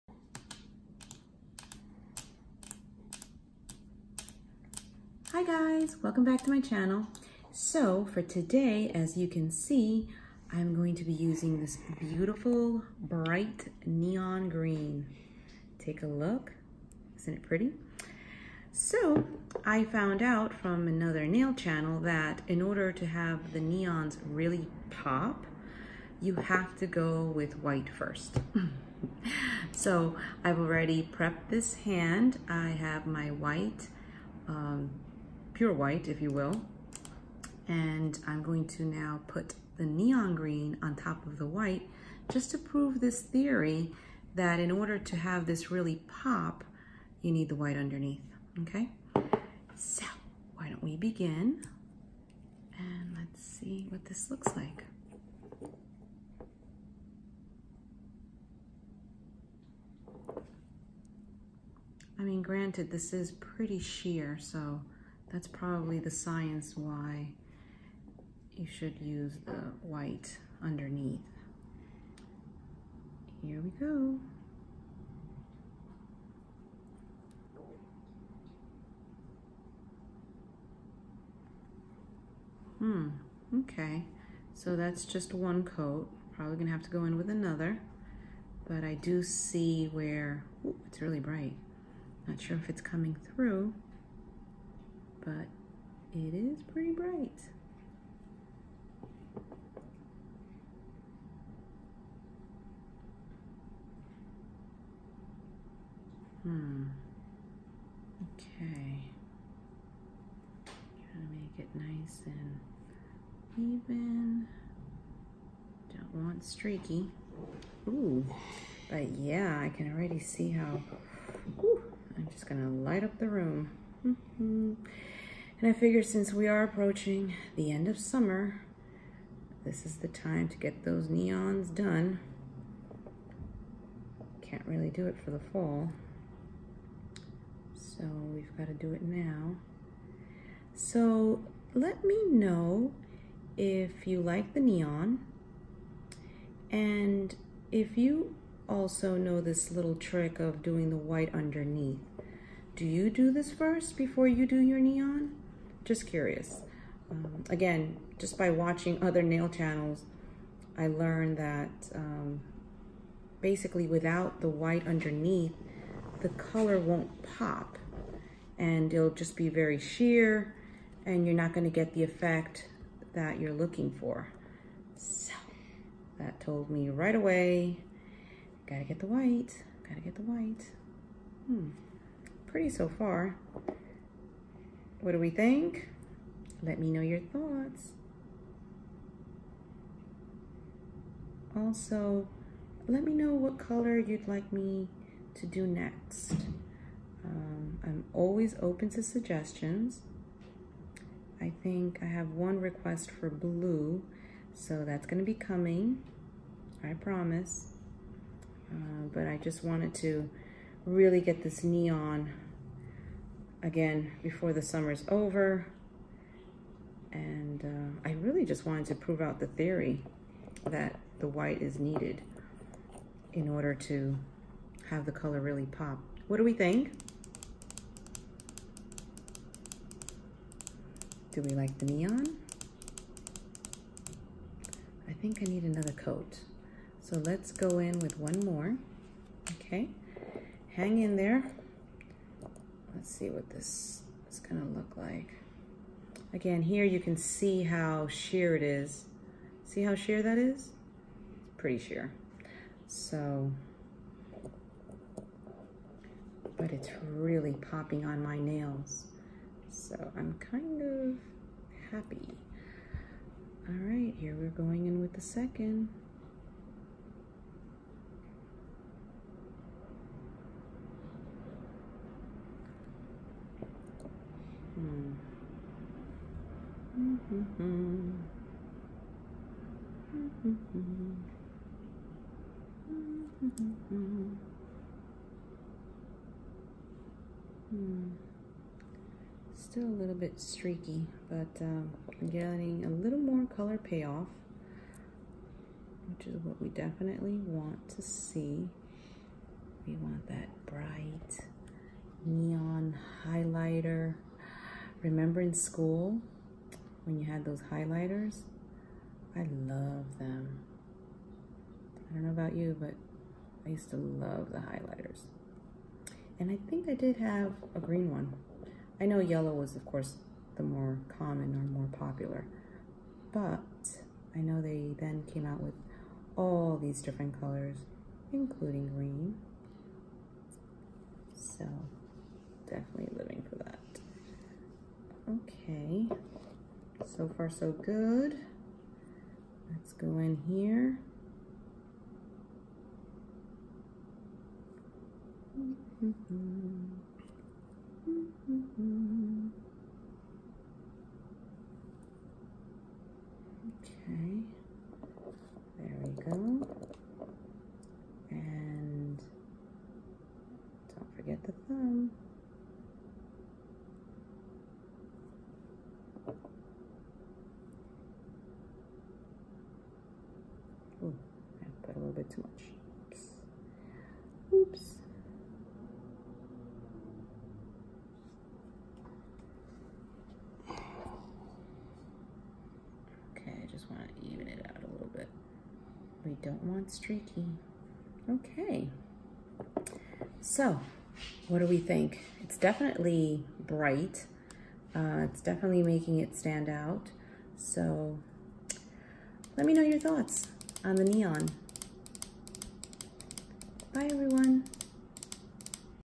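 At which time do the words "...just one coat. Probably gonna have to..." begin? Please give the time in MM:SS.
01:25.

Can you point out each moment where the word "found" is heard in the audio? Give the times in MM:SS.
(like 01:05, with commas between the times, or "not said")
00:19.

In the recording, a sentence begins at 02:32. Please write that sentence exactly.
Do you do this first before you do your neon?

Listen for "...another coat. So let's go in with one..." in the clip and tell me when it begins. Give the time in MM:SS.
03:55.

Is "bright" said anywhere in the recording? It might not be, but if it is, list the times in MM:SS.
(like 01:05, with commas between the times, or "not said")
00:12, 01:31, 01:36, 05:00, 06:33.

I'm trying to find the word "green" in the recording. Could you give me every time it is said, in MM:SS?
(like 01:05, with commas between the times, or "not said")
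00:14, 00:40, 05:17, 05:28.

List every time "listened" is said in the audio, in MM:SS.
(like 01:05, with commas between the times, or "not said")
not said.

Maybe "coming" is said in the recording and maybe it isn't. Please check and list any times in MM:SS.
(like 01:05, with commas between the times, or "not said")
01:32, 03:25.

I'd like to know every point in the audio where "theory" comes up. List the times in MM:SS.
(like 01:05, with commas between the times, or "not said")
00:43, 03:39.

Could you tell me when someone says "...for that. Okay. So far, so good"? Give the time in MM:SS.
05:33.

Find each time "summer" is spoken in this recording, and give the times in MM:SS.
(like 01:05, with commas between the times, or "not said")
02:07, 03:34.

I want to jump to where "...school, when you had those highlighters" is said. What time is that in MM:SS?
05:05.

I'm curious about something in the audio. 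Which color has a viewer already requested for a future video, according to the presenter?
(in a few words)
blue.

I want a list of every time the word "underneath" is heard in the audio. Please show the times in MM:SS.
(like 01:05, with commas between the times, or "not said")
00:47, 01:10, 02:31, 02:44.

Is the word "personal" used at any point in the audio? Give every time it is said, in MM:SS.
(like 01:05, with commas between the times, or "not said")
not said.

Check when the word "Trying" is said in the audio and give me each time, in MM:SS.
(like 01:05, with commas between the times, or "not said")
01:51.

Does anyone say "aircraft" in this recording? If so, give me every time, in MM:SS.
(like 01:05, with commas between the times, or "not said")
not said.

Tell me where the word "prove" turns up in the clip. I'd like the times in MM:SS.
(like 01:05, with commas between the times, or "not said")
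00:42, 03:38.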